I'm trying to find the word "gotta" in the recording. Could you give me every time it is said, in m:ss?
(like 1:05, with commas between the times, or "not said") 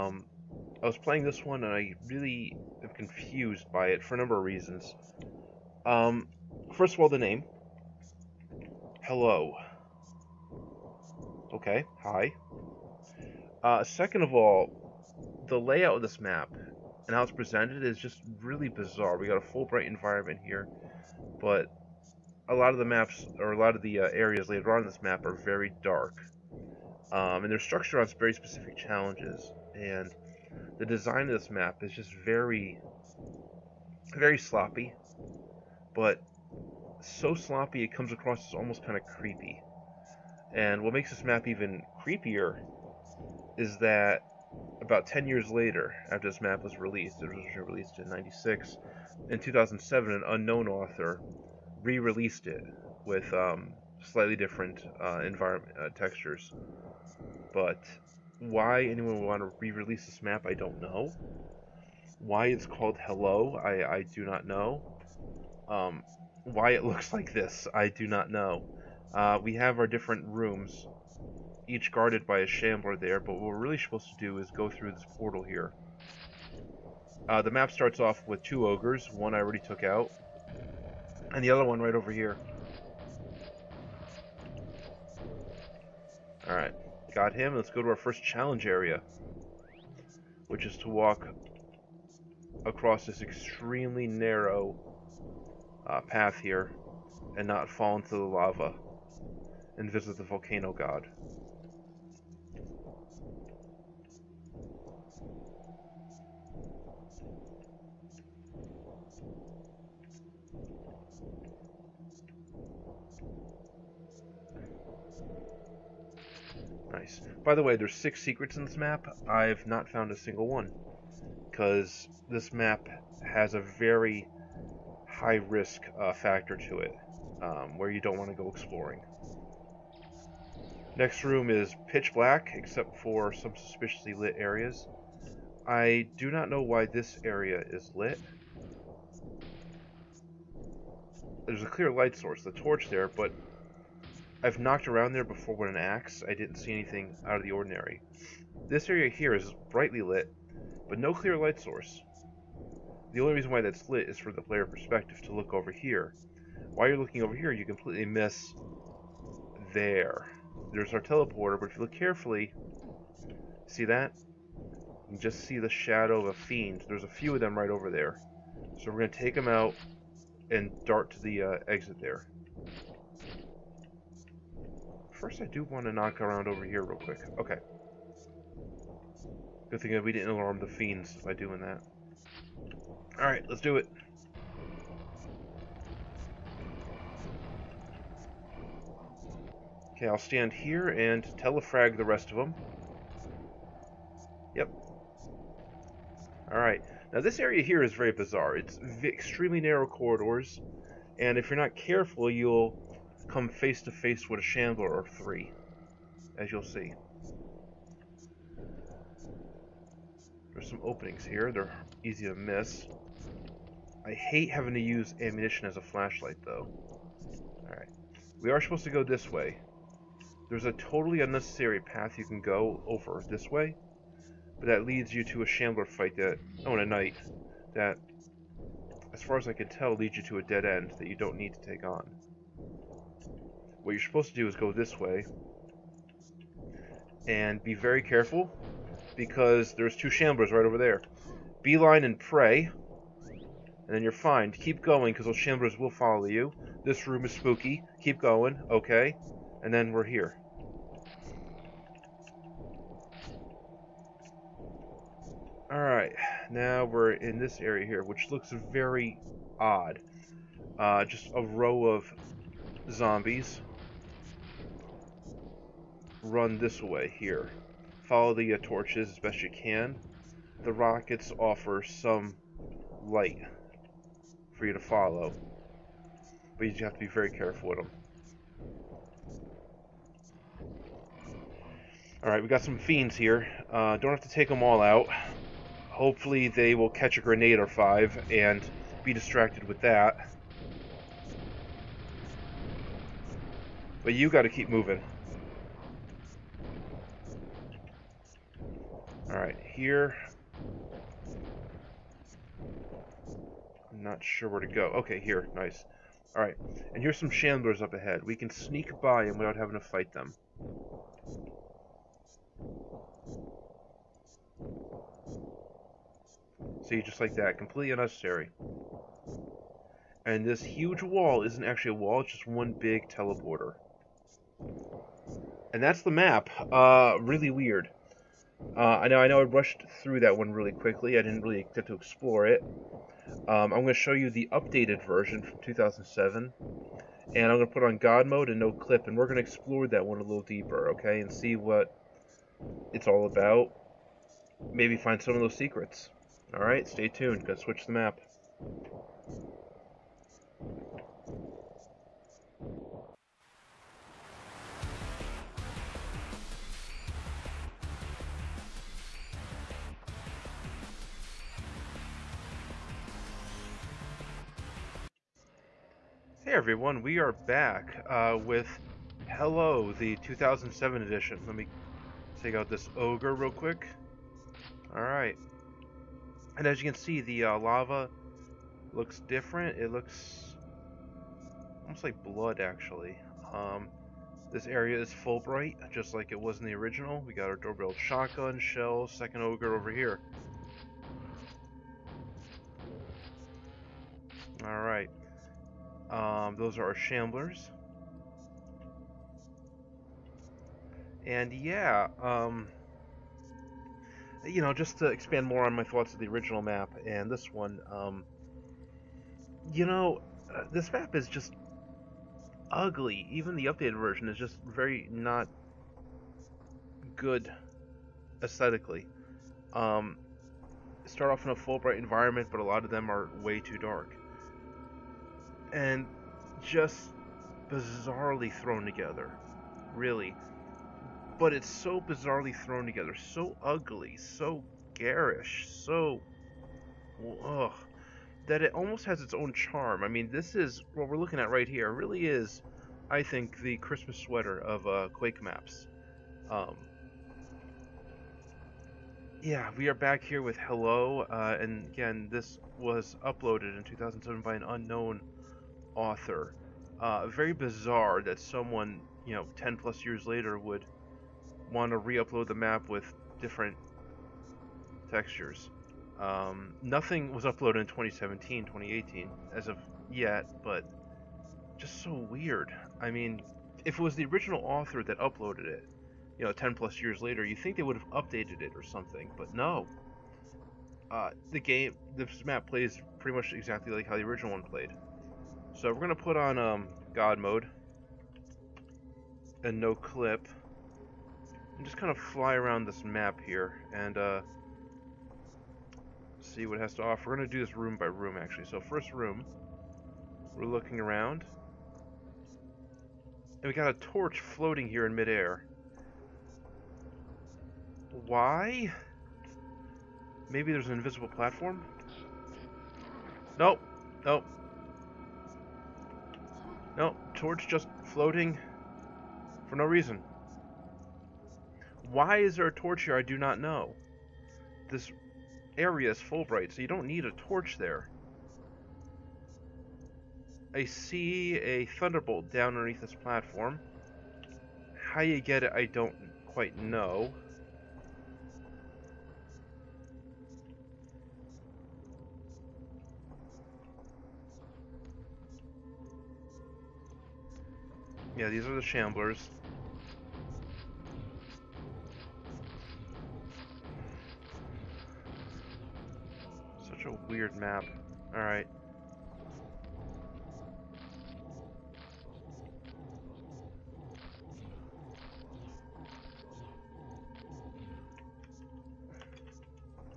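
4:54, 5:47.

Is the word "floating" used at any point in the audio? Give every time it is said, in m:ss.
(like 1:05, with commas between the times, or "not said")
8:24, 8:38.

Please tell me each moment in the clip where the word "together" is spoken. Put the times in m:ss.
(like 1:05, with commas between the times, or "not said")
7:08, 7:12.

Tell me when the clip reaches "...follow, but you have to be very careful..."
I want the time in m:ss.
4:34.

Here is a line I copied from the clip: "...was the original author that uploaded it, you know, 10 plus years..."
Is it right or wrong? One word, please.
right.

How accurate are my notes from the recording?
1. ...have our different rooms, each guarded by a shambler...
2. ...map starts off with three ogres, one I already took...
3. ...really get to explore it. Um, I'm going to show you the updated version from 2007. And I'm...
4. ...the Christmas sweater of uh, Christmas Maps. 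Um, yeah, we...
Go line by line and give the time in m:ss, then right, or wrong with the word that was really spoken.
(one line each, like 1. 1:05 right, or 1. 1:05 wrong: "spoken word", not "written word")
1. 1:09 right
2. 1:17 wrong: "two", not "three"
3. 5:31 right
4. 7:23 wrong: "Quake", not "Christmas".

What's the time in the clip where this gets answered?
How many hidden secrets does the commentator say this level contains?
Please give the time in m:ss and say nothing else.
1:57.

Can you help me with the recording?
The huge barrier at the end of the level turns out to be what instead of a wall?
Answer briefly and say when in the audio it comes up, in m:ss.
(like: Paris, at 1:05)
one big teleporter, at 5:22.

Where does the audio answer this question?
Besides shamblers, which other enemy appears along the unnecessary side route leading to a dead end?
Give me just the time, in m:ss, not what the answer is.
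3:46.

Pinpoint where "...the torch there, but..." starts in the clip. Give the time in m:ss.
2:22.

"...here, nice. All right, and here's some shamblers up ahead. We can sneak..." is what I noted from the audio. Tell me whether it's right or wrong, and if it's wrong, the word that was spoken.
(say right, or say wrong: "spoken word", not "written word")
right.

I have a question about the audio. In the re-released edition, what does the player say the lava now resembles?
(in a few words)
blood.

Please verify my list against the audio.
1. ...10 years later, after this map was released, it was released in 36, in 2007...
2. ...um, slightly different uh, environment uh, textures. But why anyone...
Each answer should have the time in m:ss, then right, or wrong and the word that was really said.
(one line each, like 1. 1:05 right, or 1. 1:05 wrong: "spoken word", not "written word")
1. 0:45 wrong: "96", not "36"
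2. 0:53 right.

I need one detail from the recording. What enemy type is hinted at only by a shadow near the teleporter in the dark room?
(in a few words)
a fiend.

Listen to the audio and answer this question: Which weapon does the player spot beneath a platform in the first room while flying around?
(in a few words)
a thunderbolt.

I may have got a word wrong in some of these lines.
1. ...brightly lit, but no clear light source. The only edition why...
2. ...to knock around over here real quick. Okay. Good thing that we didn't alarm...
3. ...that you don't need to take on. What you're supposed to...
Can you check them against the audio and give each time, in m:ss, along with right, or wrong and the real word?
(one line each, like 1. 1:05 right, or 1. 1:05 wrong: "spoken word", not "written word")
1. 2:29 wrong: "reason", not "edition"
2. 2:55 right
3. 3:50 right.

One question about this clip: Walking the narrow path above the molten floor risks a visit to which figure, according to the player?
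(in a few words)
the volcano god.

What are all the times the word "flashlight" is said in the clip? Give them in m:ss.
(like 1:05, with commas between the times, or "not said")
3:35.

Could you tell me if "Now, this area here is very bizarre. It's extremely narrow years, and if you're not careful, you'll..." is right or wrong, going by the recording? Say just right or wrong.
wrong.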